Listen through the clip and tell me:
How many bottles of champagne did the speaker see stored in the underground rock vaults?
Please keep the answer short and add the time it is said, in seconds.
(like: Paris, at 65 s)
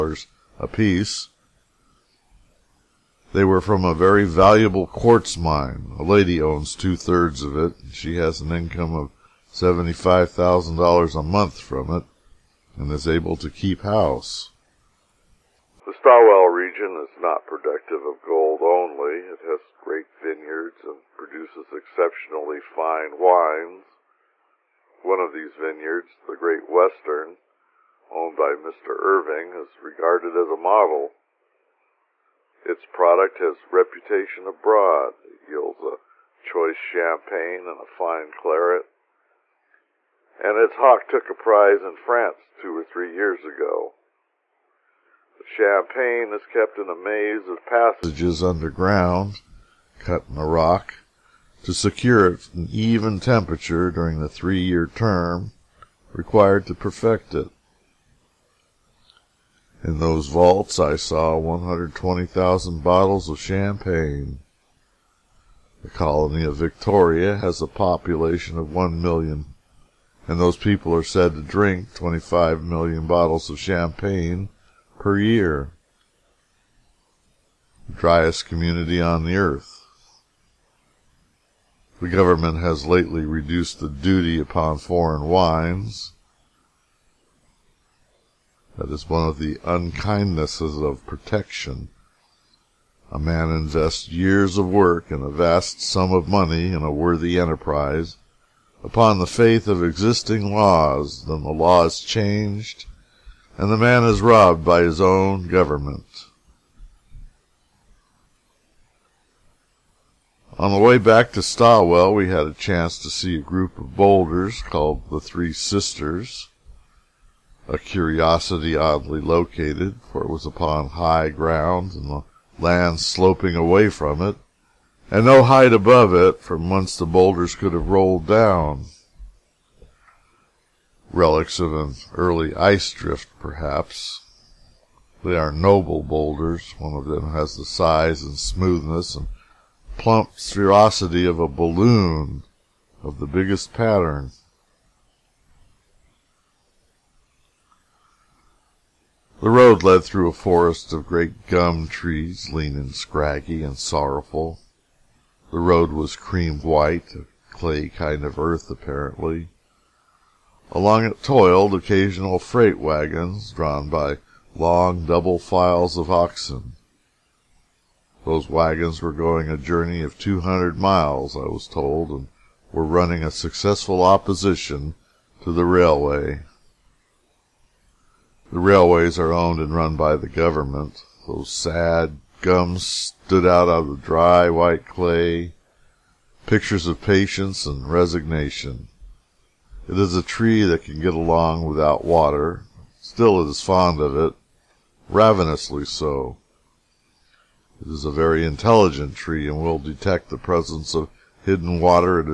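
120,000, at 61 s.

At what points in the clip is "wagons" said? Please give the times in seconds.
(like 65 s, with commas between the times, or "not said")
162 s, 168 s.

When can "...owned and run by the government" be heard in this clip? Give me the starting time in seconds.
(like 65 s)
179 s.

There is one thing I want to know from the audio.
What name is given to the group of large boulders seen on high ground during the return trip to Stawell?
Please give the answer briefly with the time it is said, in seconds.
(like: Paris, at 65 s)
The Three Sisters, at 115 s.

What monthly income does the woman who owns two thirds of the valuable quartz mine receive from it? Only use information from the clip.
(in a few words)
$75,000.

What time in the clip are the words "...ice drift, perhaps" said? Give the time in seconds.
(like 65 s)
132 s.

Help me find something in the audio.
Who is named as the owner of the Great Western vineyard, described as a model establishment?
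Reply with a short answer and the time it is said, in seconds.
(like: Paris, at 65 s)
Mr. Irving, at 28 s.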